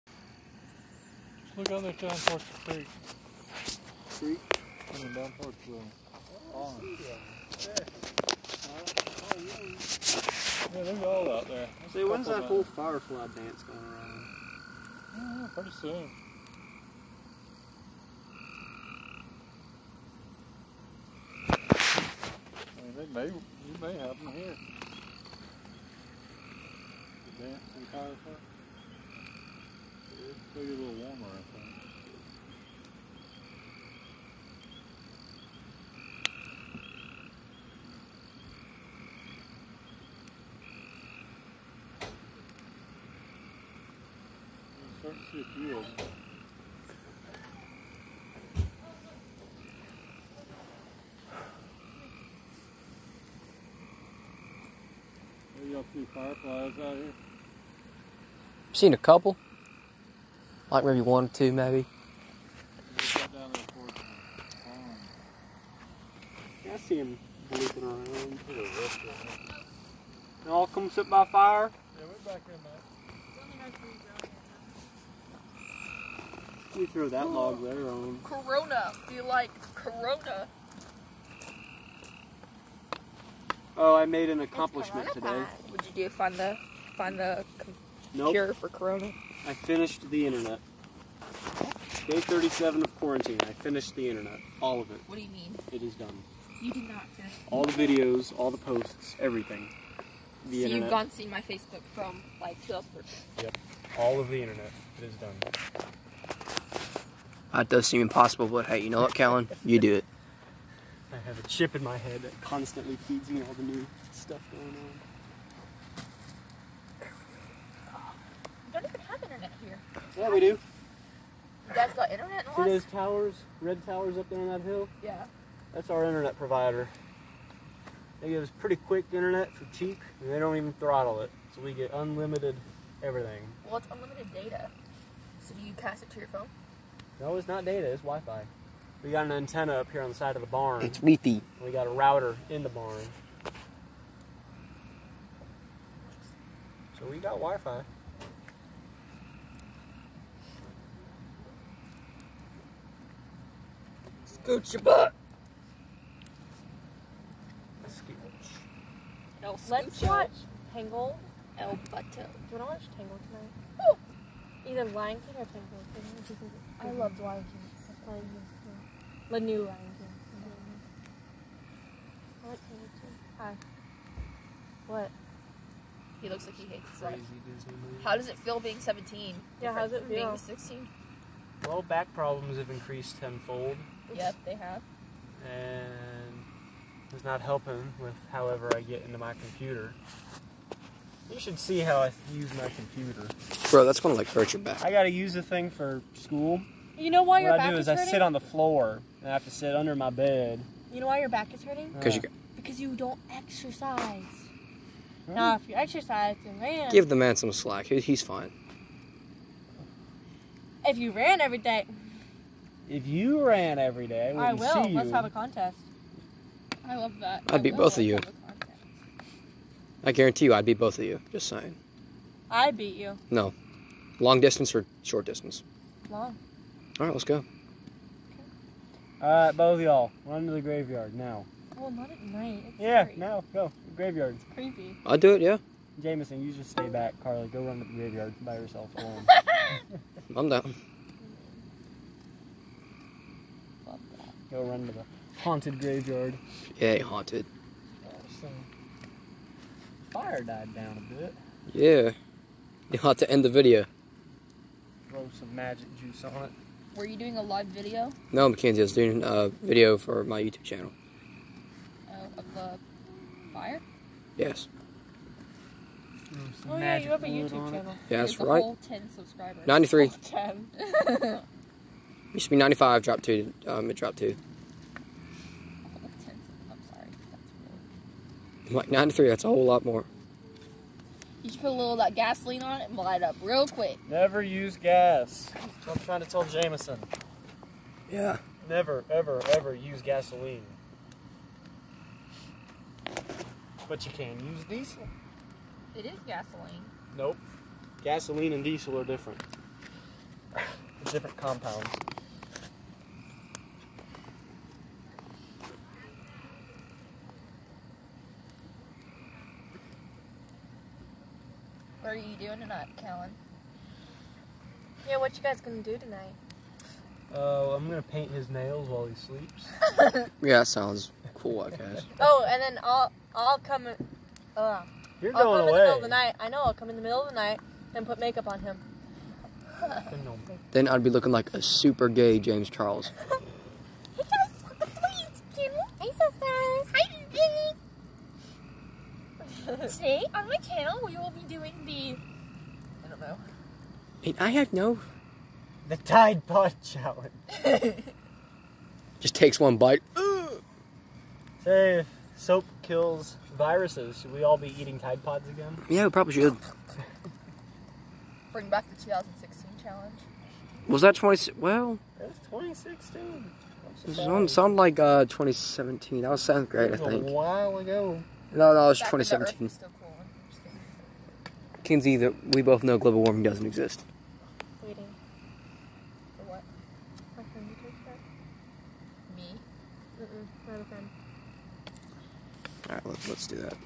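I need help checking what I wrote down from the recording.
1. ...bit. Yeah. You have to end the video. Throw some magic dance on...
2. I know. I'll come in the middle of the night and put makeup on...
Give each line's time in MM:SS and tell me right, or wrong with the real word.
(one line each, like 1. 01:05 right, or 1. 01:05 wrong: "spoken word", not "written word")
1. 04:11 wrong: "juice", not "dance"
2. 05:26 right.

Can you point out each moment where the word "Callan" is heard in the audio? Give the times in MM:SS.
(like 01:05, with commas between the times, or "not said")
01:49, 05:12.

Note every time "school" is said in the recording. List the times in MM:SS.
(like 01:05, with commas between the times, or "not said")
03:16.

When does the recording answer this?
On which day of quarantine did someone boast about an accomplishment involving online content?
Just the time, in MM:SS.
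01:32.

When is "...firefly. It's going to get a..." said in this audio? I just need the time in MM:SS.
00:27.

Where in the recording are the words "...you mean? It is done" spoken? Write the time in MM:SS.
01:35.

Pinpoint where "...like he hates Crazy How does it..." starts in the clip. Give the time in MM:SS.
02:56.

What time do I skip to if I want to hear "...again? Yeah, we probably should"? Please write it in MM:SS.
05:55.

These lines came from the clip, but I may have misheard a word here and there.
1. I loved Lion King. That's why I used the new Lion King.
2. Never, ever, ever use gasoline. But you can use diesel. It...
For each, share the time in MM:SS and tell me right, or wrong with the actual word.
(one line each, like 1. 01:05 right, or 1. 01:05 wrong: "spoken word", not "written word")
1. 02:46 right
2. 04:48 right.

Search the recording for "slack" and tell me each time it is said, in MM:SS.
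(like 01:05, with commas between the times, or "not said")
03:27.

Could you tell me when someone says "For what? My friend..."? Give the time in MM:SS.
06:16.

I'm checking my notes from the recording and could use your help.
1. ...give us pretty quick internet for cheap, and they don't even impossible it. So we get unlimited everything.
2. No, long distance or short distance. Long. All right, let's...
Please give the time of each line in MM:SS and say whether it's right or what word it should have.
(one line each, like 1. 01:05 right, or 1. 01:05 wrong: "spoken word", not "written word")
1. 02:08 wrong: "throttle", not "impossible"
2. 03:43 right.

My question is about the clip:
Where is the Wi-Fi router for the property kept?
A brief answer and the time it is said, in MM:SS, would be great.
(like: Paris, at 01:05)
In the barn, at 02:22.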